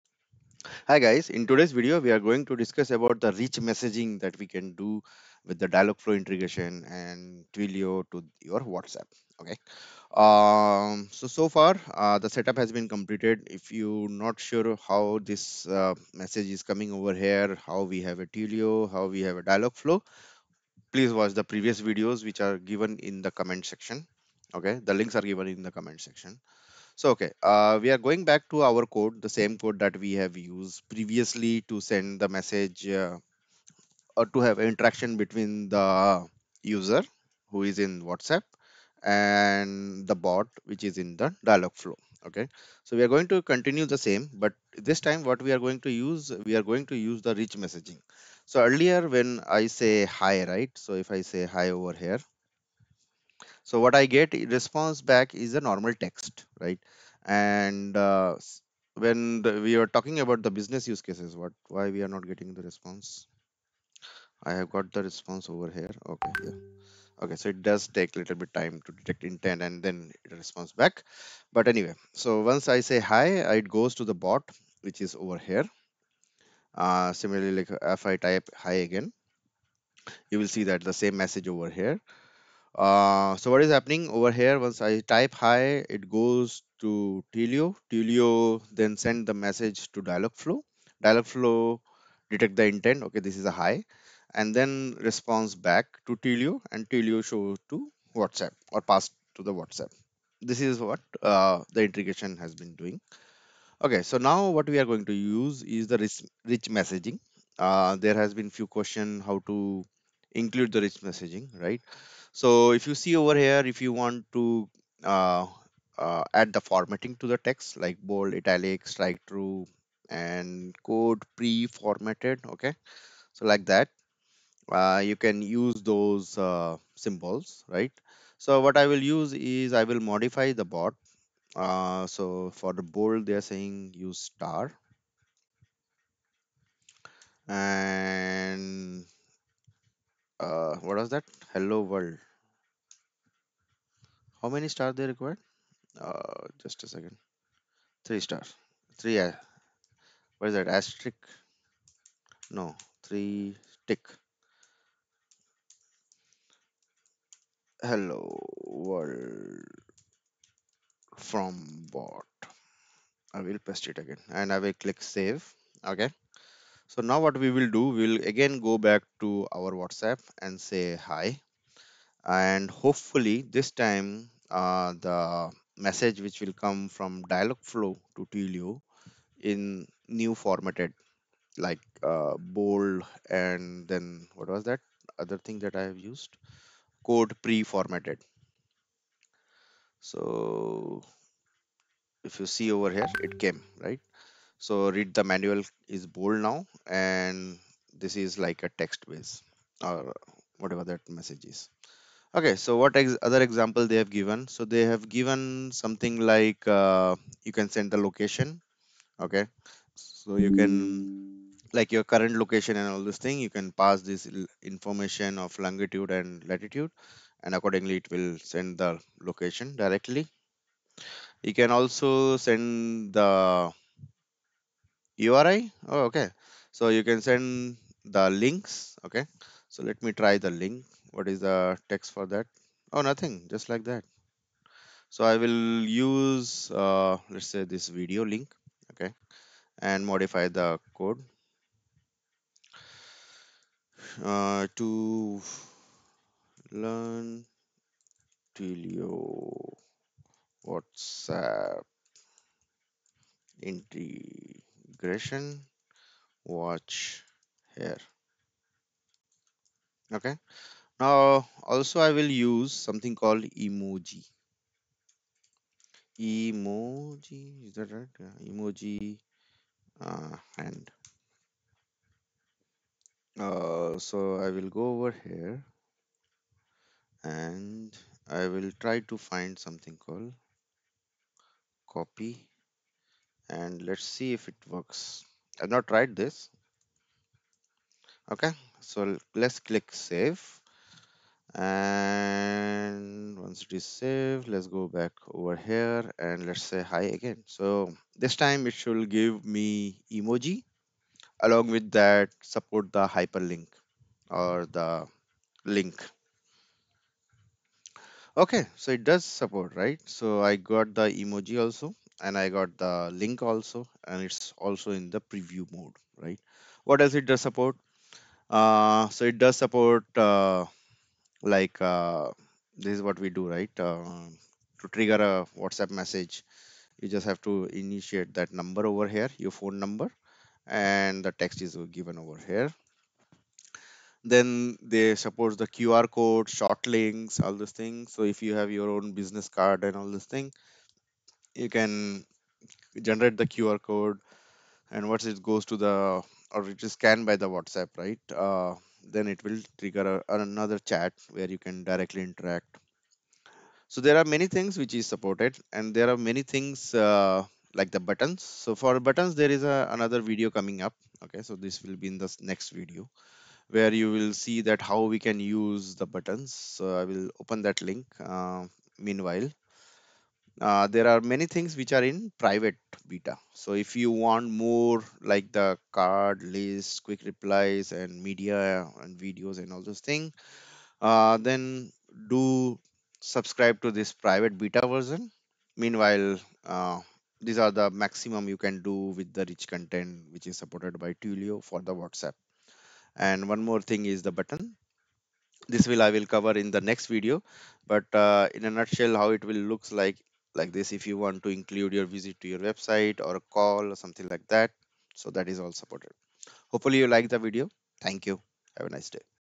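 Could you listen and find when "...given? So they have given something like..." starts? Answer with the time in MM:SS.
03:24.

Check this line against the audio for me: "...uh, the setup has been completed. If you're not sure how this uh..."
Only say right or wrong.
right.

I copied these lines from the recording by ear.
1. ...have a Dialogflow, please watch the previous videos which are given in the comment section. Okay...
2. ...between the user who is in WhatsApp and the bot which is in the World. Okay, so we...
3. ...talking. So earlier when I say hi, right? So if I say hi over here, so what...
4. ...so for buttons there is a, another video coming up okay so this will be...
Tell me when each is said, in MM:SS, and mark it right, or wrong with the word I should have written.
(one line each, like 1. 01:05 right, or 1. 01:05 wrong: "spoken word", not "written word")
1. 00:19 right
2. 00:35 wrong: "Dialogflow", not "World"
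3. 00:47 wrong: "messaging", not "talking"
4. 05:58 right.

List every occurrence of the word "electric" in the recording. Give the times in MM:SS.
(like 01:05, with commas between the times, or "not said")
not said.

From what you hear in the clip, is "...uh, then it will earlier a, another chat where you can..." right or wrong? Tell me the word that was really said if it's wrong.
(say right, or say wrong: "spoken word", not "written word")
wrong: "trigger", not "earlier".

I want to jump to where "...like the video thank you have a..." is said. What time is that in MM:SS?
06:47.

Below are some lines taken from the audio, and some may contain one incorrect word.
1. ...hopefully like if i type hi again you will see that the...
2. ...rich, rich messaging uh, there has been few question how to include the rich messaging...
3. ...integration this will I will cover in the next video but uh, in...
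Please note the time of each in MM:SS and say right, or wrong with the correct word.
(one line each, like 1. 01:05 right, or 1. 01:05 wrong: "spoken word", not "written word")
1. 01:17 wrong: "similarly", not "hopefully"
2. 01:45 right
3. 06:34 wrong: "button", not "integration".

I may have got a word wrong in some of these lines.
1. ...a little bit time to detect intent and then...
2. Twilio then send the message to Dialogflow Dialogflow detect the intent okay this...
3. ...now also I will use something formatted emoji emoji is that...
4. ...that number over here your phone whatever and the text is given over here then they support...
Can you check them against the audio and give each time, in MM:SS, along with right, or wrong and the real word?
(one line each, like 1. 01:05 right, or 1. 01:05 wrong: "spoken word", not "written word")
1. 01:08 right
2. 01:27 right
3. 04:20 wrong: "called", not "formatted"
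4. 05:28 wrong: "number", not "whatever".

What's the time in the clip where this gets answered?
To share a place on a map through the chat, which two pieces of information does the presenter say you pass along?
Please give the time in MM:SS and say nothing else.
03:35.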